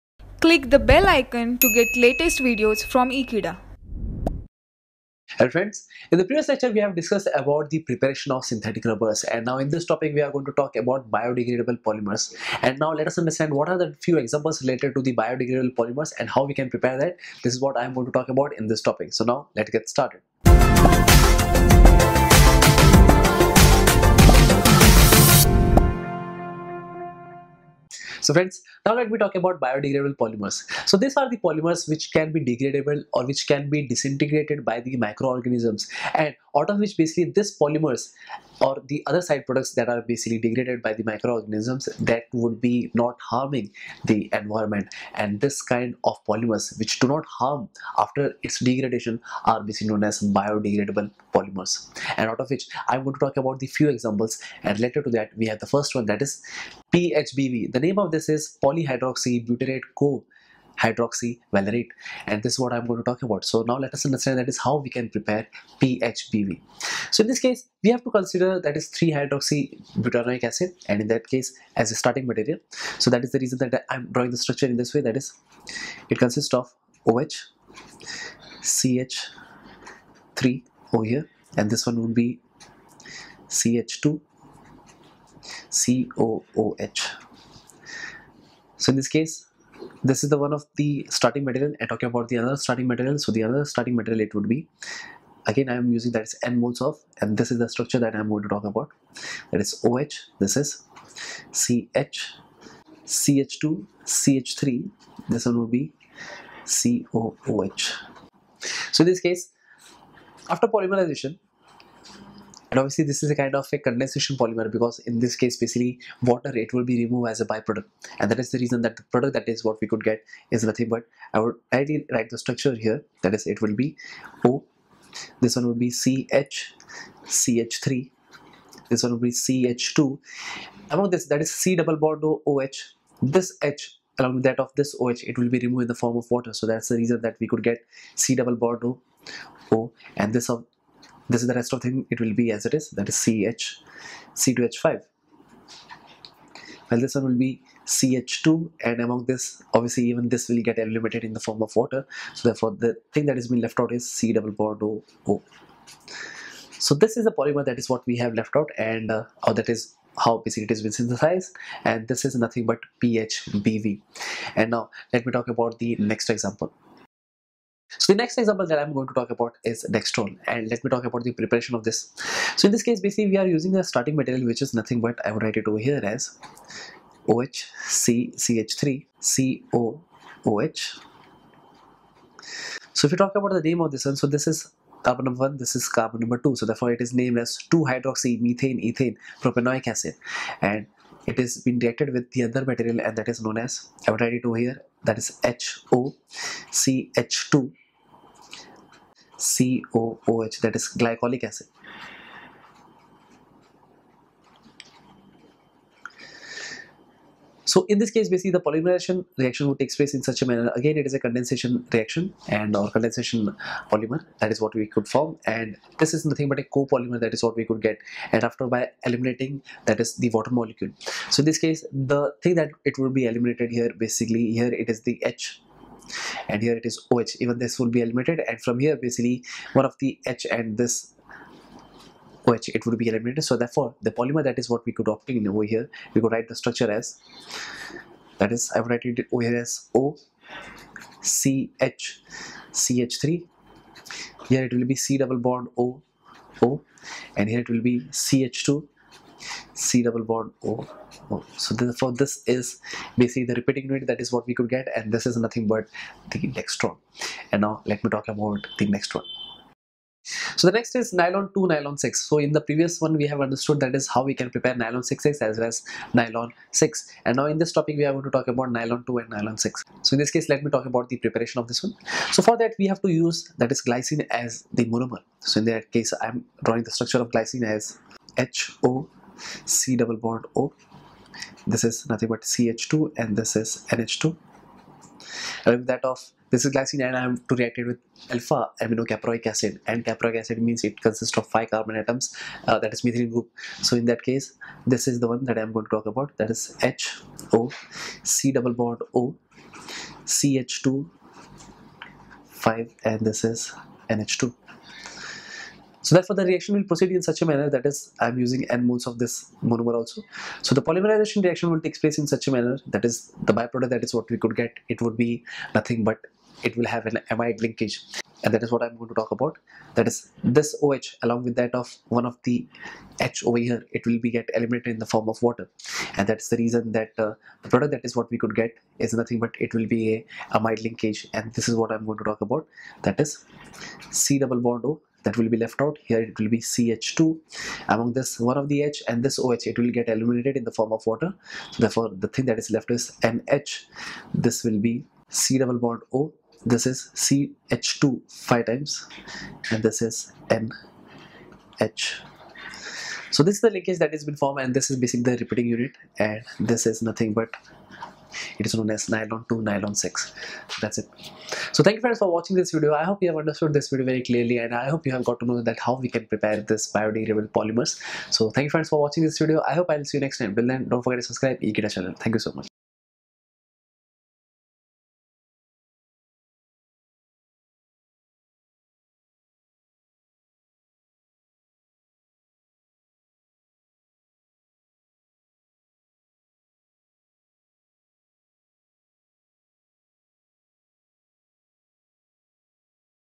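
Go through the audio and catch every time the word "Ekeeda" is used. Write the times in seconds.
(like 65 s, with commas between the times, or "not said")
3 s, 371 s.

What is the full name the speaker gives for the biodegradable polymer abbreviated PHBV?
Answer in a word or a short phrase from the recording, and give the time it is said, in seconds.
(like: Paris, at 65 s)
polyhydroxybutyrate co hydroxy valerate, at 58 s.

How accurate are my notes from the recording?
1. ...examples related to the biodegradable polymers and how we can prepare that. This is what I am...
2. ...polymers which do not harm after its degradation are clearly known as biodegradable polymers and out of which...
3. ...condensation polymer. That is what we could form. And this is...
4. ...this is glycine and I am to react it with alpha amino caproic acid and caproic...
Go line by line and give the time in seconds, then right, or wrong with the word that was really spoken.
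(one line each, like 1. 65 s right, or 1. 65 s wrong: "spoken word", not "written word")
1. 14 s right
2. 46 s wrong: "basically", not "clearly"
3. 212 s right
4. 286 s right.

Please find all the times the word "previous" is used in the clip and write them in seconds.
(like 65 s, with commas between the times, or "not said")
6 s, 262 s.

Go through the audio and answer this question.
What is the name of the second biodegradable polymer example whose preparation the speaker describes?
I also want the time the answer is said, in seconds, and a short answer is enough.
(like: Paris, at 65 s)
Dextron, at 169 s.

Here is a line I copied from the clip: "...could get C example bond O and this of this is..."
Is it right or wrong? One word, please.
wrong.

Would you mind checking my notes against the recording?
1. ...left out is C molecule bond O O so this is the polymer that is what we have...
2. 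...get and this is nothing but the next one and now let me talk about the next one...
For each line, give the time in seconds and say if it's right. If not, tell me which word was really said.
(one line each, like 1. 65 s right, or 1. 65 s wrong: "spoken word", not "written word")
1. 153 s wrong: "double", not "molecule"
2. 254 s right.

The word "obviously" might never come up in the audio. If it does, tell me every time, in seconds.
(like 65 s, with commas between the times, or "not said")
112 s, 149 s.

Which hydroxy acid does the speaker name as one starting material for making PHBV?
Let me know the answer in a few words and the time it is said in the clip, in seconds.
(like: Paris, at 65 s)
3-hydroxybutyric acid, at 68 s.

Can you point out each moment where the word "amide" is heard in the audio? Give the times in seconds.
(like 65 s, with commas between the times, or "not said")
317 s, 330 s.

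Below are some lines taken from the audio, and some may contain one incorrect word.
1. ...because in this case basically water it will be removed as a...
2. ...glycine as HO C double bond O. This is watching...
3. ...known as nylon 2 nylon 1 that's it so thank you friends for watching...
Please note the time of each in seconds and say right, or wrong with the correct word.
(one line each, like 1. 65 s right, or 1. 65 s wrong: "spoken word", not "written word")
1. 114 s right
2. 277 s wrong: "nothing", not "watching"
3. 358 s wrong: "6", not "1".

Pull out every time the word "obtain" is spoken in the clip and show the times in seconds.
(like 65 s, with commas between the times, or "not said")
235 s.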